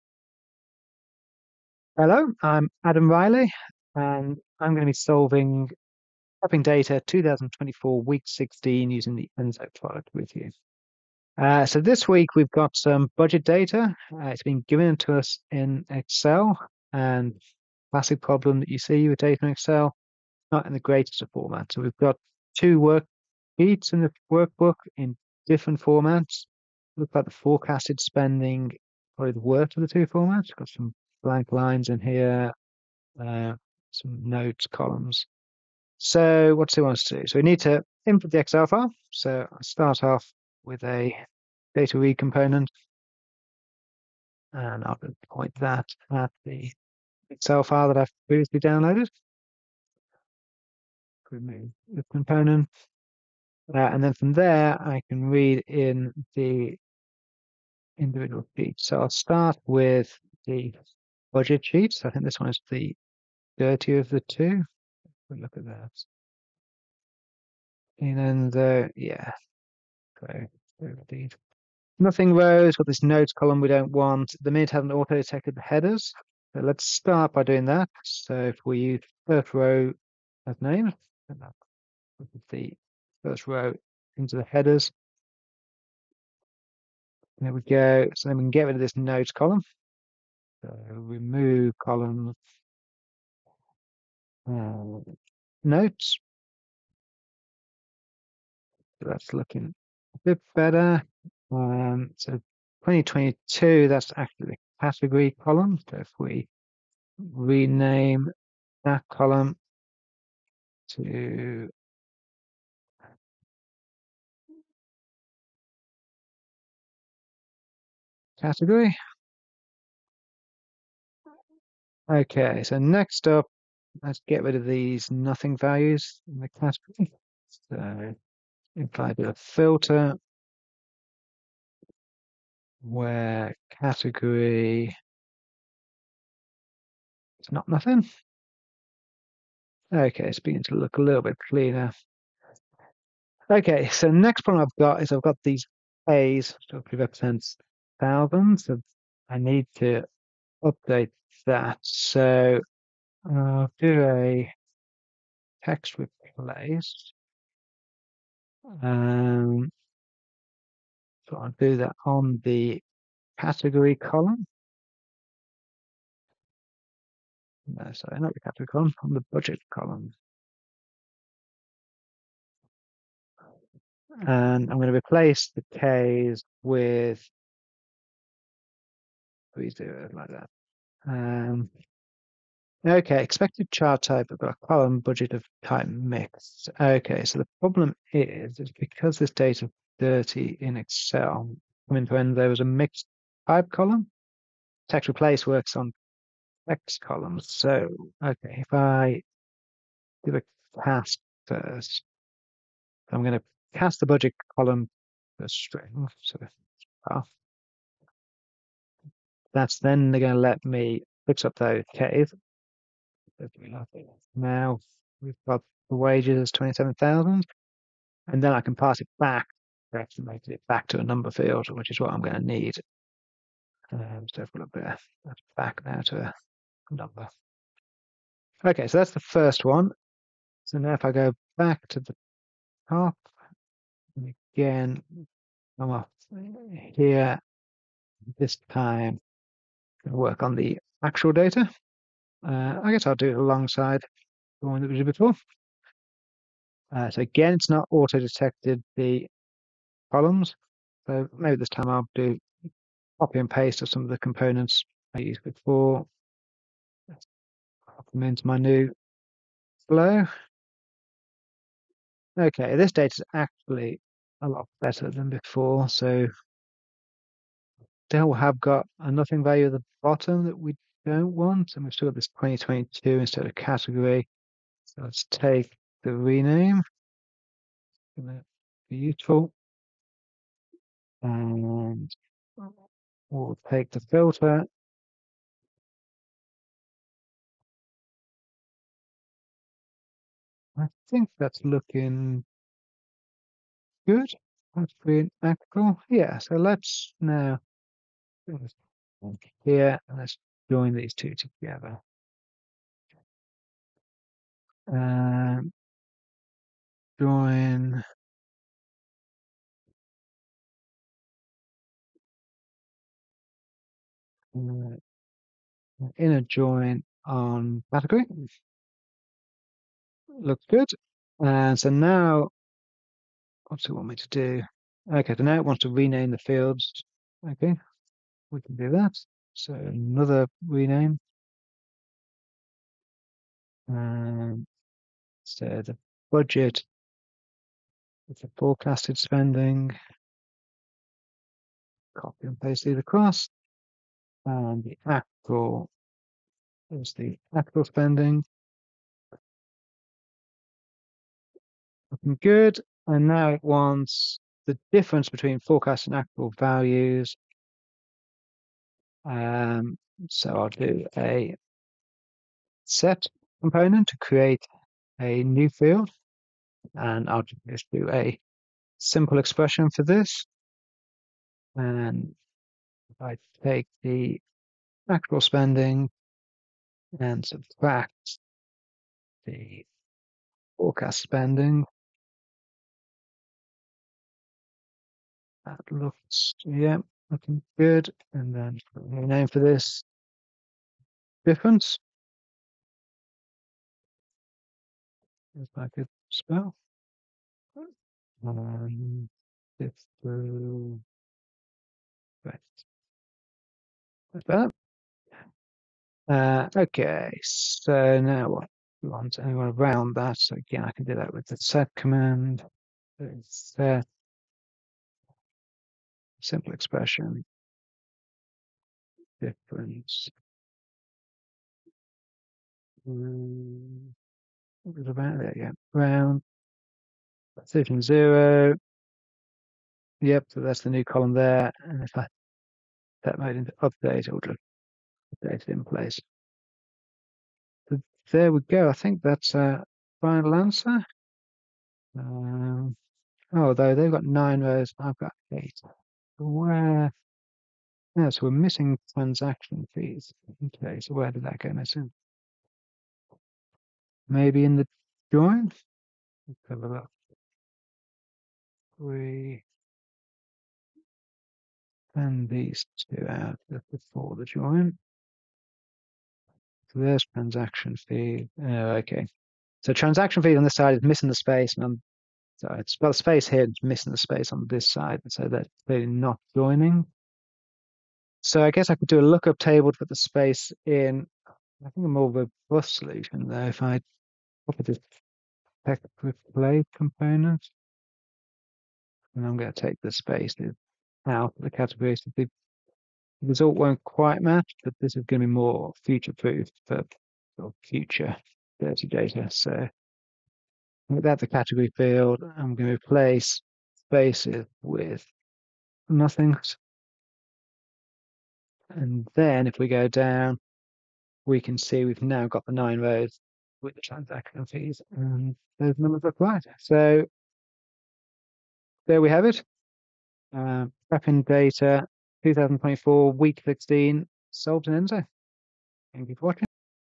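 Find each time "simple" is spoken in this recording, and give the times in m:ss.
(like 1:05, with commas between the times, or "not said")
6:08, 6:56.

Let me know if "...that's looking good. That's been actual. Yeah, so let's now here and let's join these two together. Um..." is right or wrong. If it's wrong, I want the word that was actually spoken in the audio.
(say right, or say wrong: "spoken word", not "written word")
right.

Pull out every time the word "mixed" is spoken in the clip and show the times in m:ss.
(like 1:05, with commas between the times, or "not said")
3:05, 3:12.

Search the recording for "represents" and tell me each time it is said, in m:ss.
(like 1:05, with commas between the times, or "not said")
2:26.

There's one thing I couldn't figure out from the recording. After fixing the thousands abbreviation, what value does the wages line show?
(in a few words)
27,000.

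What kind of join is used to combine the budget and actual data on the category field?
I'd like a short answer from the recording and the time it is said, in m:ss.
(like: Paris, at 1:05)
inner join, at 5:16.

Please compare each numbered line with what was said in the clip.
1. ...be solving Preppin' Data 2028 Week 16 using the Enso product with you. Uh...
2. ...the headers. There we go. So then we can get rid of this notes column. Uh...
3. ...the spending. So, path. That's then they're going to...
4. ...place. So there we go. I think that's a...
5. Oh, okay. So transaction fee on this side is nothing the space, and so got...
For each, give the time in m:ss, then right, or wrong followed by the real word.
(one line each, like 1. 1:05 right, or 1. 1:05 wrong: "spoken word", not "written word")
1. 0:04 wrong: "2024", not "2028"
2. 1:24 right
3. 3:25 wrong: "string", not "spending"
4. 7:15 right
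5. 7:48 wrong: "missing", not "nothing".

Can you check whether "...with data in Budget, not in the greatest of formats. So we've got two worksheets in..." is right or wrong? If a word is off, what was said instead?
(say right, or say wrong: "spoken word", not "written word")
wrong: "Excel", not "Budget".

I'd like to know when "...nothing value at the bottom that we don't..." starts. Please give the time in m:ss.
4:28.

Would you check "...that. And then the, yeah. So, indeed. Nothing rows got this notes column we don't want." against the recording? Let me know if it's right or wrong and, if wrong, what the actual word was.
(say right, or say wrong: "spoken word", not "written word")
right.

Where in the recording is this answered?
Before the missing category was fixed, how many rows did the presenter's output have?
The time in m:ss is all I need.
7:25.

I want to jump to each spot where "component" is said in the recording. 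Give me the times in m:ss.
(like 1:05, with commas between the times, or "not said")
0:42, 0:52, 4:14, 6:03, 8:06.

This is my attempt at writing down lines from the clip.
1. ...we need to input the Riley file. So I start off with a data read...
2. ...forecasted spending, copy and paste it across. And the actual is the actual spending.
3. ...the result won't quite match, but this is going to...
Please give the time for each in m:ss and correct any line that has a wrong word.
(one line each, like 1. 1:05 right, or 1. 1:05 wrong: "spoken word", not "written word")
1. 0:37 wrong: "Excel", not "Riley"
2. 5:38 right
3. 8:12 right.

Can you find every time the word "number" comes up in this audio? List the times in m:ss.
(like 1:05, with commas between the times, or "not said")
3:41, 3:46, 8:35.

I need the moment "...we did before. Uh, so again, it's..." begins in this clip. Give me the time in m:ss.
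4:04.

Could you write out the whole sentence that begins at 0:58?
So I'll start with the Budget sheets.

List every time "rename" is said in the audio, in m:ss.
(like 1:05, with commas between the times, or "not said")
1:47, 4:36, 5:25, 5:30.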